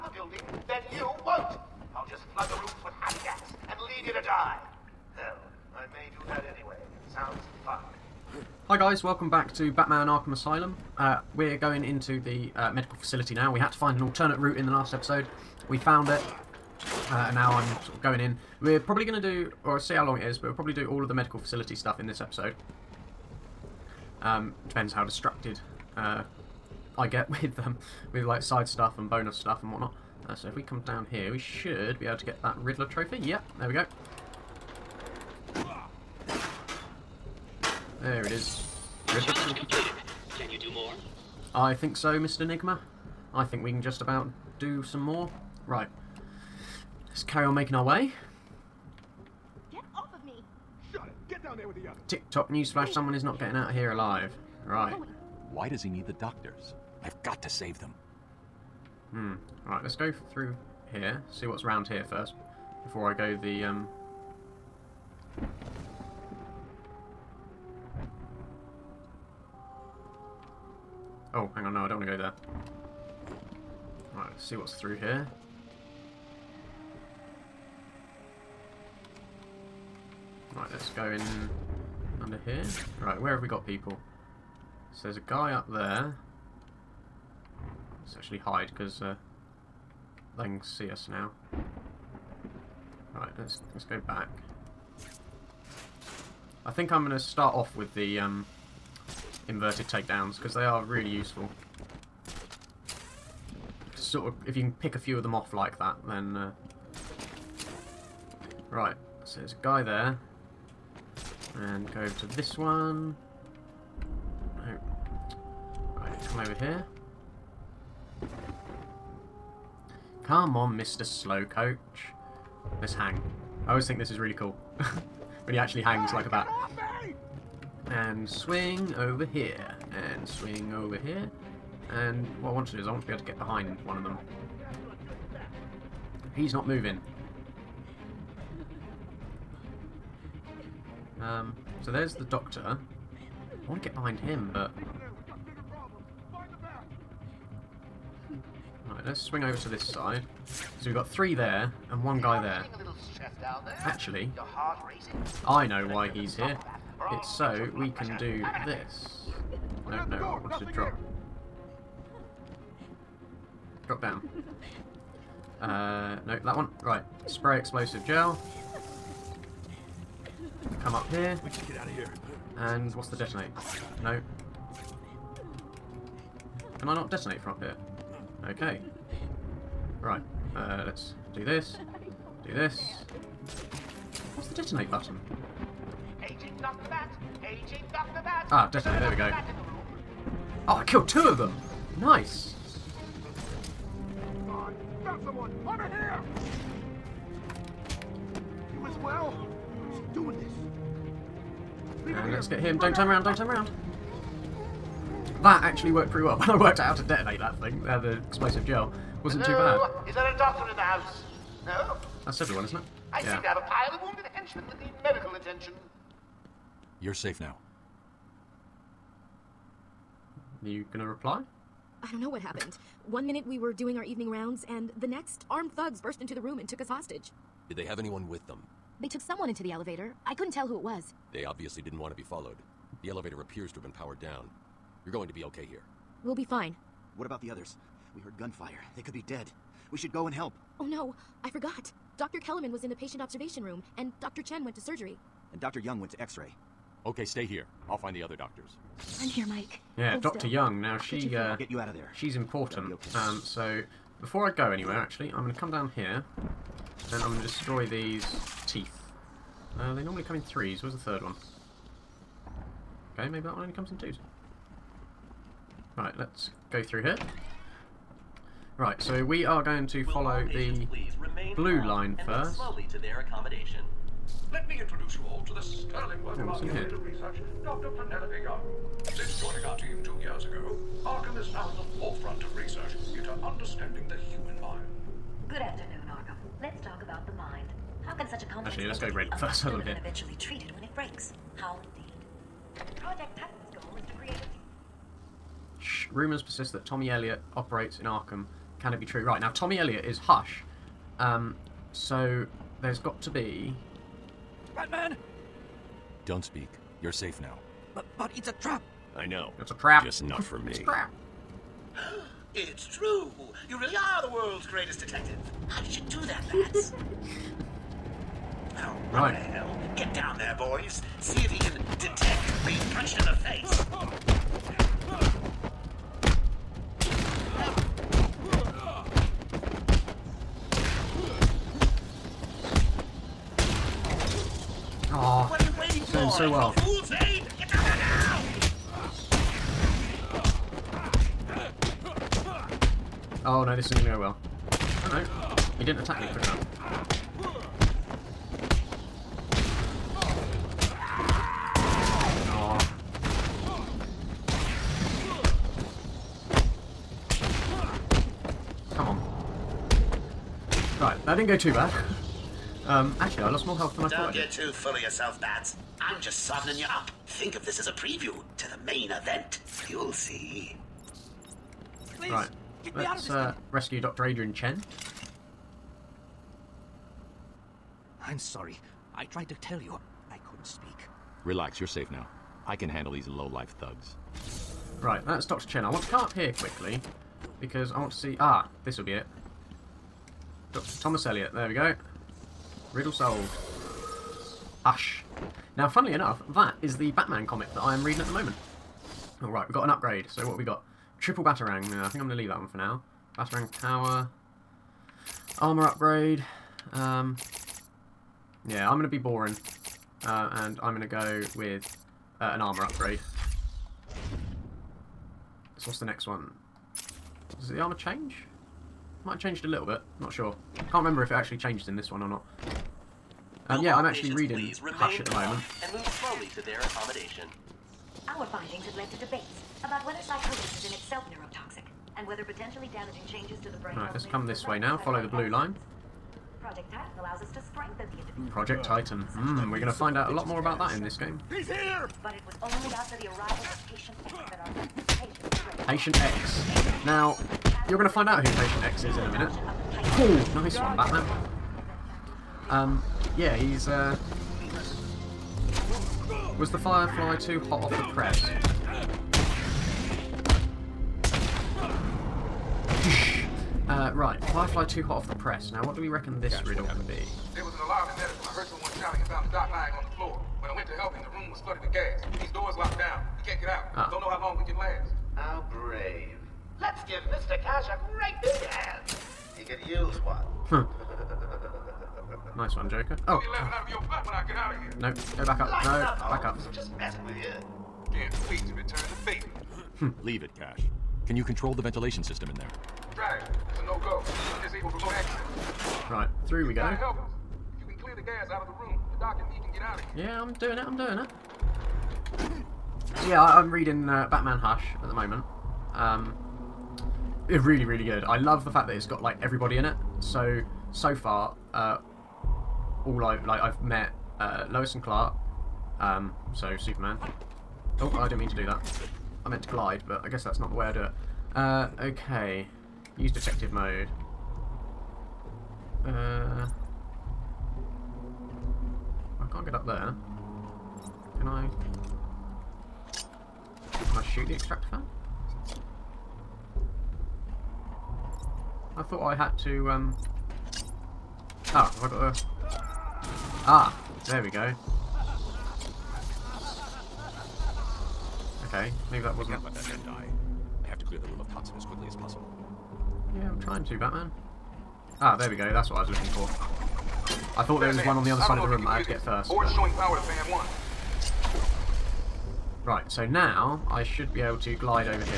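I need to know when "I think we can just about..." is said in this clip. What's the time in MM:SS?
00:43.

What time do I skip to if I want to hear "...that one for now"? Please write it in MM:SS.
06:42.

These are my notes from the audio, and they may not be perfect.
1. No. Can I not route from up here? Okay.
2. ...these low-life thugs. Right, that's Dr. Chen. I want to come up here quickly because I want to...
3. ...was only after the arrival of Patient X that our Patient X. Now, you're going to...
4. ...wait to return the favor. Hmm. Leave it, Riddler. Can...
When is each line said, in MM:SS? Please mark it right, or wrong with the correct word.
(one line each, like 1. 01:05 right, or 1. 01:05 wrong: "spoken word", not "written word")
1. 02:54 wrong: "detonate", not "route"
2. 06:23 right
3. 07:22 right
4. 08:08 wrong: "Cash", not "Riddler".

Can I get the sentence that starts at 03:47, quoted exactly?
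Did they have anyone with them?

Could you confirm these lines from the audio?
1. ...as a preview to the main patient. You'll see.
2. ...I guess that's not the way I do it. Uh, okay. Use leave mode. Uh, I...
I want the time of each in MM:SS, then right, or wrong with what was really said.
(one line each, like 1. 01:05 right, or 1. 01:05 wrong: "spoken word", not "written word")
1. 06:07 wrong: "event", not "patient"
2. 08:40 wrong: "detective", not "leave".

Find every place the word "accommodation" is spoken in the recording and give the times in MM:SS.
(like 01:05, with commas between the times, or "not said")
07:06.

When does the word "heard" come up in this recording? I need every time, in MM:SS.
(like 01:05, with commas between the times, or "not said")
03:58.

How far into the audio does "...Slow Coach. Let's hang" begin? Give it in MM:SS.
02:01.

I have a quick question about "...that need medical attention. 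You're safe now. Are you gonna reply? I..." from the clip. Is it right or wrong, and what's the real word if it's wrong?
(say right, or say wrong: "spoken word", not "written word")
right.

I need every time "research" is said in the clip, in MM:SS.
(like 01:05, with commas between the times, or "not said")
04:36, 04:42.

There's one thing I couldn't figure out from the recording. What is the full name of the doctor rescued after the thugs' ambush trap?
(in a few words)
Dr. Adrian Chen.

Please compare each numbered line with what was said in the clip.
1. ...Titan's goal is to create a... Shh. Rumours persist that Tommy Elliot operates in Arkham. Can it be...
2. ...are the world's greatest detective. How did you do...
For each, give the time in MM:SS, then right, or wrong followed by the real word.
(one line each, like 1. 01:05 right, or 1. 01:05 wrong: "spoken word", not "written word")
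1. 04:53 right
2. 05:13 right.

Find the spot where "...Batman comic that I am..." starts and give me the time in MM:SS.
06:37.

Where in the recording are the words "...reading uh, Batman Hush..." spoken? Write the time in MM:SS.
08:23.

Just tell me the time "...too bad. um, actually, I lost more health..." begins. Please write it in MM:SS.
06:01.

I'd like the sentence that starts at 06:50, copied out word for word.
Uh, and I'm going to go with uh, an armor upgrade.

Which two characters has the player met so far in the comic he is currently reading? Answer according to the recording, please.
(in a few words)
Lois and Clark.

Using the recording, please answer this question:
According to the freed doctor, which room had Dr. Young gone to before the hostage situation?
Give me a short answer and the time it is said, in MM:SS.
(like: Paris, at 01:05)
X-ray, at 04:06.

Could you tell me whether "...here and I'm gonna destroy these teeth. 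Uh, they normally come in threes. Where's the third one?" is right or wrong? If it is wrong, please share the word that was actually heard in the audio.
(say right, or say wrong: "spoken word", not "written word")
right.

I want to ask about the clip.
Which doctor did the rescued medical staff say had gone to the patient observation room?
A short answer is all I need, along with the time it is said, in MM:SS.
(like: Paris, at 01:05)
Dr. Kellerman, at 04:02.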